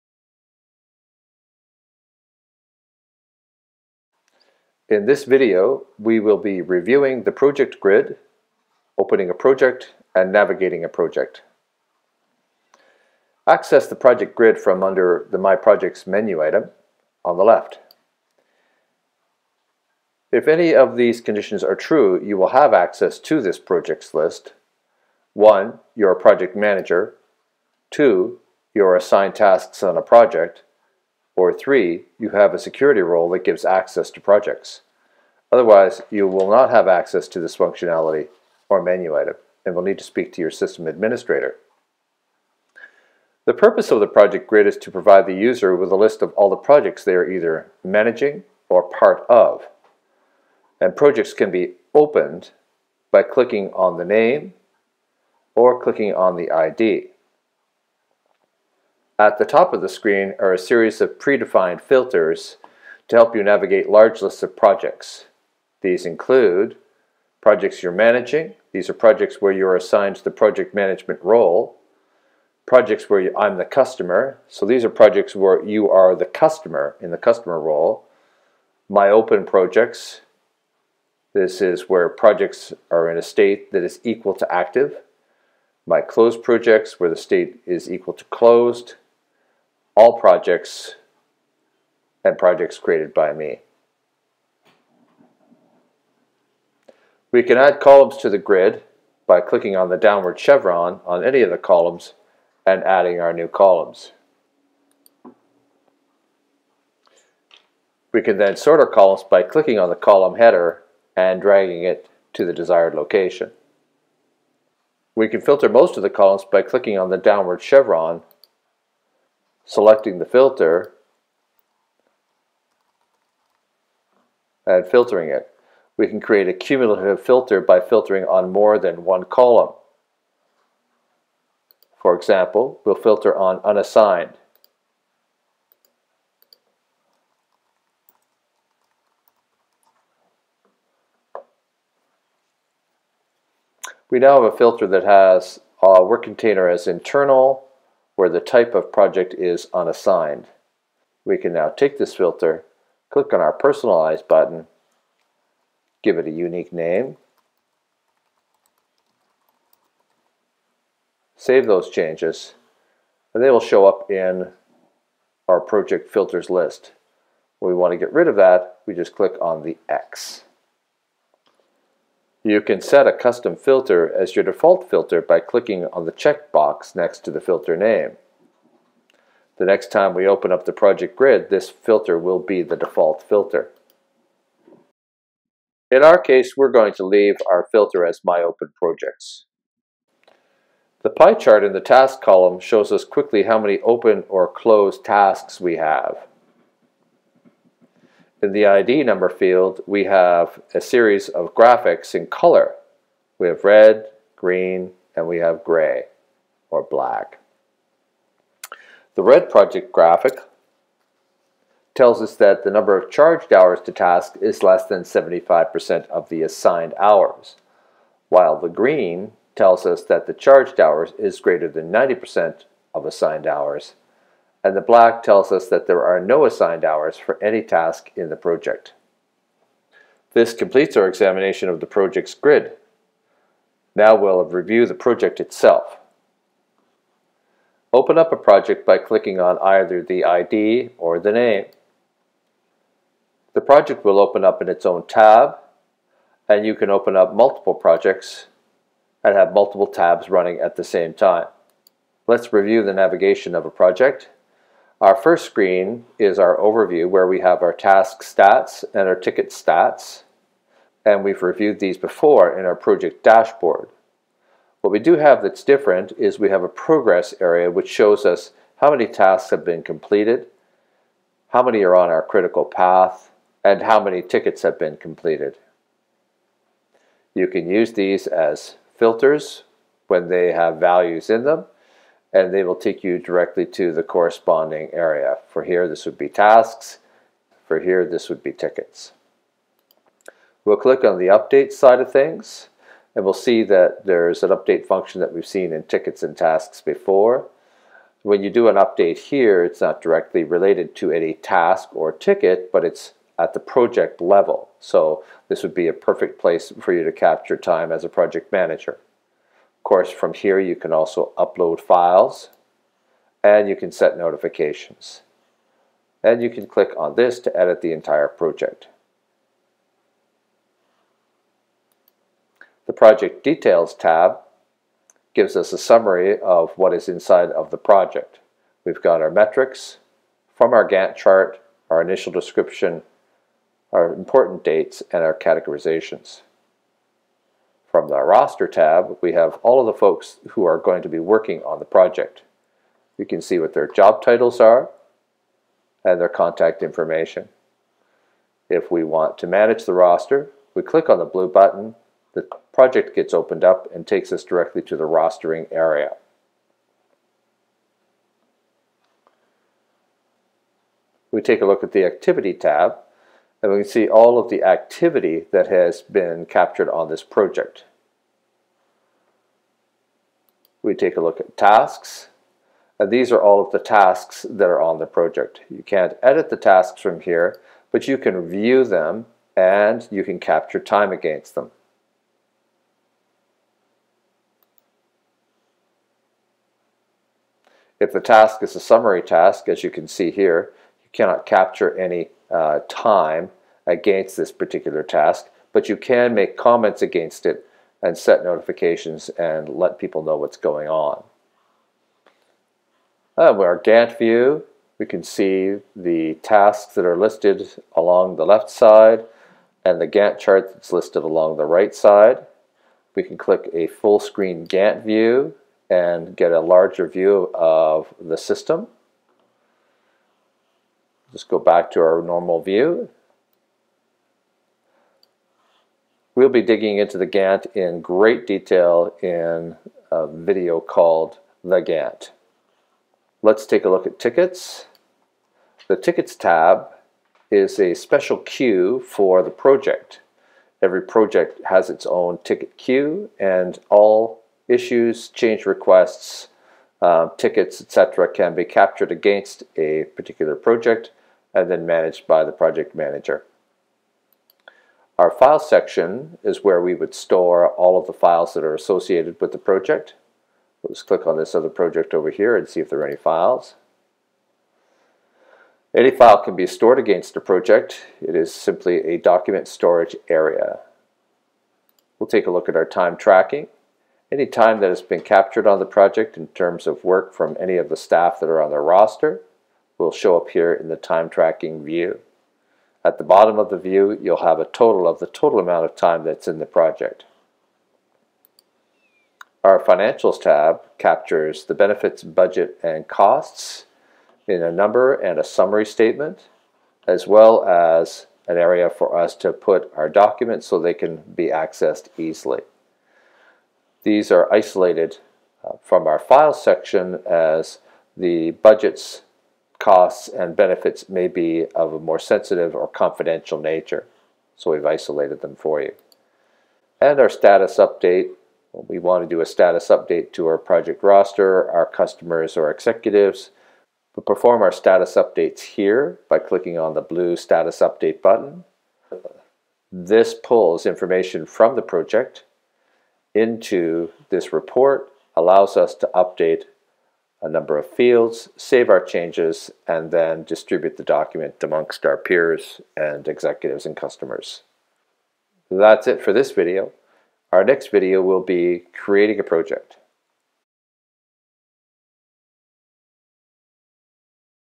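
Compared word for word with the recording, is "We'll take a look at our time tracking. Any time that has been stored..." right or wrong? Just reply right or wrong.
wrong.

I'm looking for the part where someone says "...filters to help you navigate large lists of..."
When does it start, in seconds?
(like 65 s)
61 s.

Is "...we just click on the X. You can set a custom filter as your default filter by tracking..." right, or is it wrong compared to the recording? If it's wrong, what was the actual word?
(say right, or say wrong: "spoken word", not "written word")
wrong: "clicking", not "tracking".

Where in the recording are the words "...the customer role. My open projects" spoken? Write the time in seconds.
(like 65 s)
77 s.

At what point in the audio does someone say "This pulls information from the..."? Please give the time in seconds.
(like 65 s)
529 s.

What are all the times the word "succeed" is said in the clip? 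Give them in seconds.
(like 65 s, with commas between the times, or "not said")
not said.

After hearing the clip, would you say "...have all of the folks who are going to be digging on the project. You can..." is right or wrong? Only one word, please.
wrong.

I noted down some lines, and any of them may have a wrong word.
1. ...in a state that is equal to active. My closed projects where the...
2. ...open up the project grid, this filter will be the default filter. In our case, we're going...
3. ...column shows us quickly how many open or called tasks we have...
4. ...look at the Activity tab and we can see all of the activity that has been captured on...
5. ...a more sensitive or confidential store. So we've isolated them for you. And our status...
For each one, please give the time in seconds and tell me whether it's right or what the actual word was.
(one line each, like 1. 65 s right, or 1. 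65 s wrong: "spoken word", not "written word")
1. 83 s right
2. 180 s right
3. 192 s wrong: "closed", not "called"
4. 361 s right
5. 511 s wrong: "nature", not "store".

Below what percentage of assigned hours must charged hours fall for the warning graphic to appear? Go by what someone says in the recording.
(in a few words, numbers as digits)
75%.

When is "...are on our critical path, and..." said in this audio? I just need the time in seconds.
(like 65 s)
271 s.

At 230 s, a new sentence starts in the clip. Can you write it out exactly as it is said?
This completes our examination of the project's grid.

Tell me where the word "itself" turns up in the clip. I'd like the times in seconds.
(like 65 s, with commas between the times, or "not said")
235 s.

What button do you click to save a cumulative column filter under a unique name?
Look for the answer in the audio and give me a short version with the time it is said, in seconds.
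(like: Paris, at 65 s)
personalize, at 153 s.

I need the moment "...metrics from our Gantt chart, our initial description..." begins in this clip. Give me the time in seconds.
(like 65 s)
329 s.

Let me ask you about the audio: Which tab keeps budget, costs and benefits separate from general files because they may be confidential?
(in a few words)
Financials.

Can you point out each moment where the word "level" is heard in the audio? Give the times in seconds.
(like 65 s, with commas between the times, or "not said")
304 s.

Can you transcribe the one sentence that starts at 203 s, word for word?
We have red, green, and we have gray or black.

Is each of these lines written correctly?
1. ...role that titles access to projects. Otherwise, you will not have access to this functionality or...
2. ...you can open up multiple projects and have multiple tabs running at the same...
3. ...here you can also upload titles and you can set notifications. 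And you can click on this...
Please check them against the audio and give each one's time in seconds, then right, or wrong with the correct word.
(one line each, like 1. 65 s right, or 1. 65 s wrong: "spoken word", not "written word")
1. 33 s wrong: "gives", not "titles"
2. 246 s right
3. 310 s wrong: "files", not "titles".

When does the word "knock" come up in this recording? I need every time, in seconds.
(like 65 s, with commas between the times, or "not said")
not said.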